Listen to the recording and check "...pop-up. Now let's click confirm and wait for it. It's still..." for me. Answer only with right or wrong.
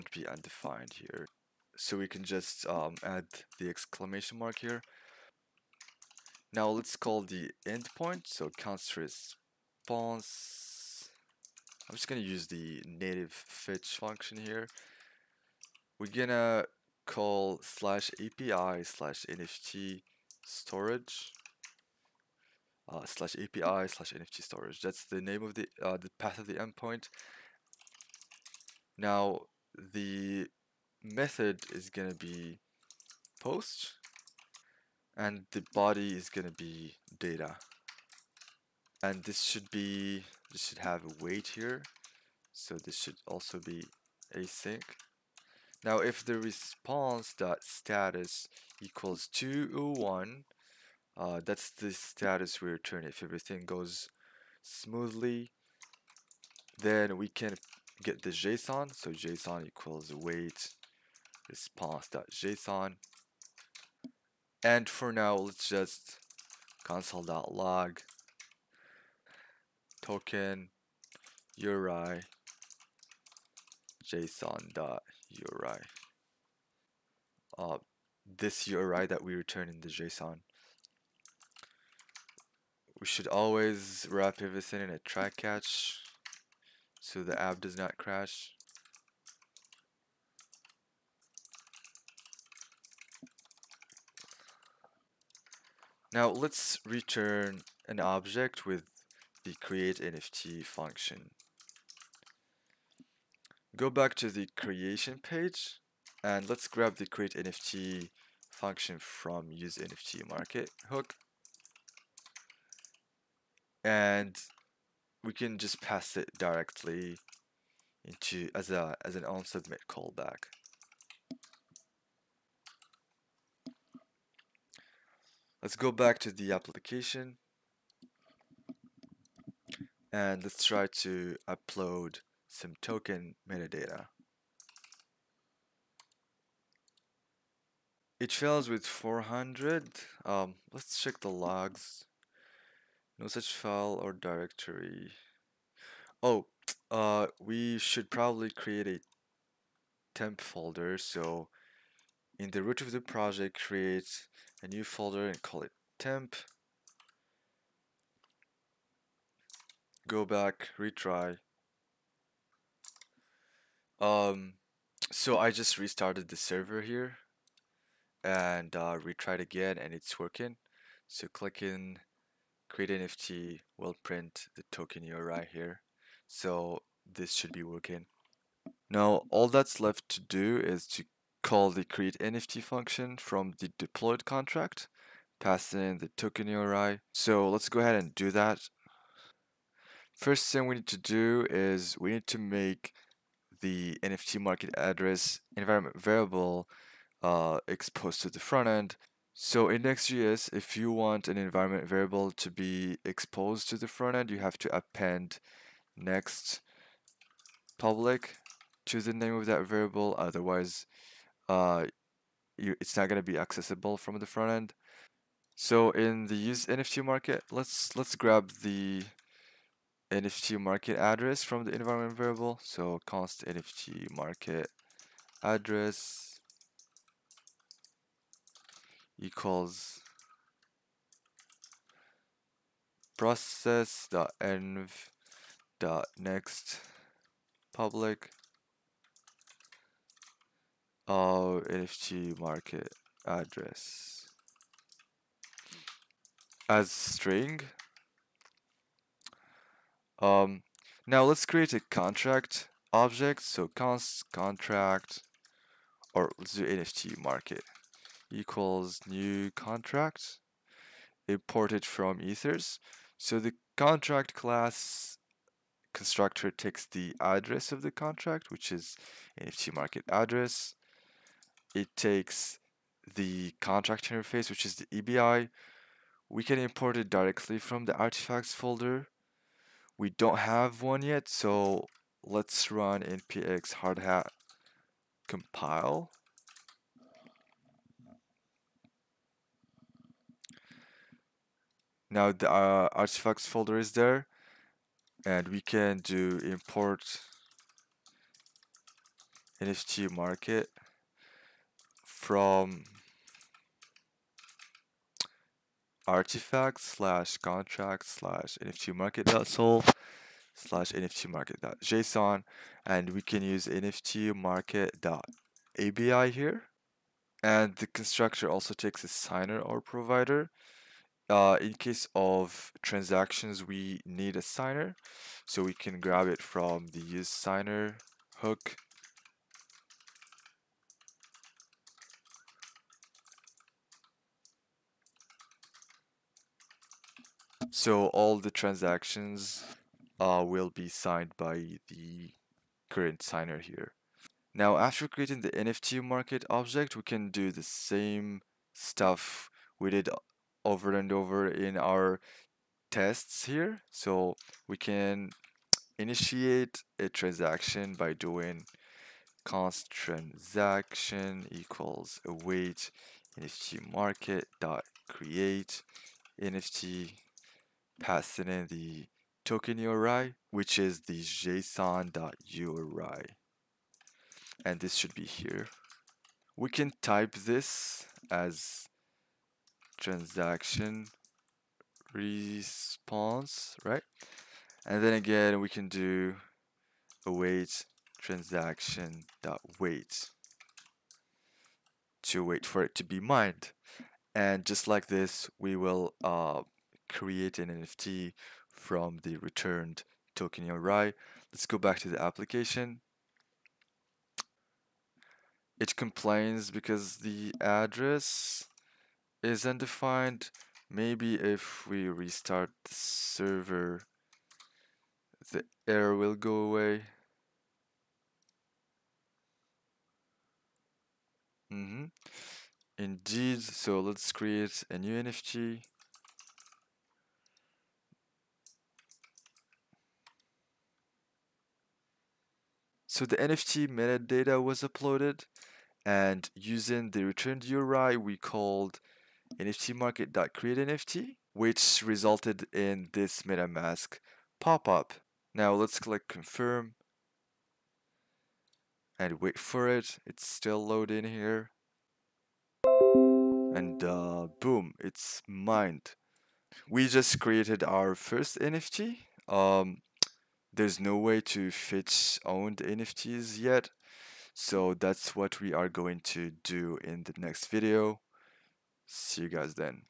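right.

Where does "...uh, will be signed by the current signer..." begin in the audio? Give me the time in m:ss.
5:40.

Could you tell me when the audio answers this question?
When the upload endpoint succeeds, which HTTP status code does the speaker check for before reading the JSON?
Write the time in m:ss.
0:49.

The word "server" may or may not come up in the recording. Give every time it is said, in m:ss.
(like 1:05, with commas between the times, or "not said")
2:46, 6:52.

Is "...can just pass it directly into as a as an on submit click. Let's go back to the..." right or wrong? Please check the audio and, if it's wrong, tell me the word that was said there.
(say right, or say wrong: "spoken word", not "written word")
wrong: "callback", not "click".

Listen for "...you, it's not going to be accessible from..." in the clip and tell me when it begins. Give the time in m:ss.
3:32.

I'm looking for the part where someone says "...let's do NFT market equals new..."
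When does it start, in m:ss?
4:16.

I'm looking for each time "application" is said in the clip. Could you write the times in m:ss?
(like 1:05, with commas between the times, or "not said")
2:06, 6:42.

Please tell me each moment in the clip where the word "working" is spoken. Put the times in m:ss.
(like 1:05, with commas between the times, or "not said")
2:50, 2:57.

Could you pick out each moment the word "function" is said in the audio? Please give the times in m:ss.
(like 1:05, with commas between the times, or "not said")
0:13, 1:40, 1:48, 3:02.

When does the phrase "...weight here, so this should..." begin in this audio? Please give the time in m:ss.
0:41.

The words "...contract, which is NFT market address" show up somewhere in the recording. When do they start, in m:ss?
4:27.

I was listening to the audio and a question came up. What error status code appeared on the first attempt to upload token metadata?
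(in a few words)
400.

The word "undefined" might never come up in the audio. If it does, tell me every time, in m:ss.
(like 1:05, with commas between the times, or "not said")
0:00, 6:49.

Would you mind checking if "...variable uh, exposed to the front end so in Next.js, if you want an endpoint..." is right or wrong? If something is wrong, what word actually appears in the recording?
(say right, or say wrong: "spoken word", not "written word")
wrong: "environment", not "endpoint".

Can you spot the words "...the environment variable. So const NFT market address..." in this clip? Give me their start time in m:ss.
3:41.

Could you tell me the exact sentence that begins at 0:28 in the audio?
Now the method is gonna be post, and the body is gonna be data.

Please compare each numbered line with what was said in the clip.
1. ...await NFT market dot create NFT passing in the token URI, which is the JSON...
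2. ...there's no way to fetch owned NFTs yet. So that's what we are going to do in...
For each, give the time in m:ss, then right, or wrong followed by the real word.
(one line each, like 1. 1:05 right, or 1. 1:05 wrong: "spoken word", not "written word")
1. 6:02 right
2. 7:40 right.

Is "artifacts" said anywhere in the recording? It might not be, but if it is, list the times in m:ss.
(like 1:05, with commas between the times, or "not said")
4:37, 4:52, 5:06.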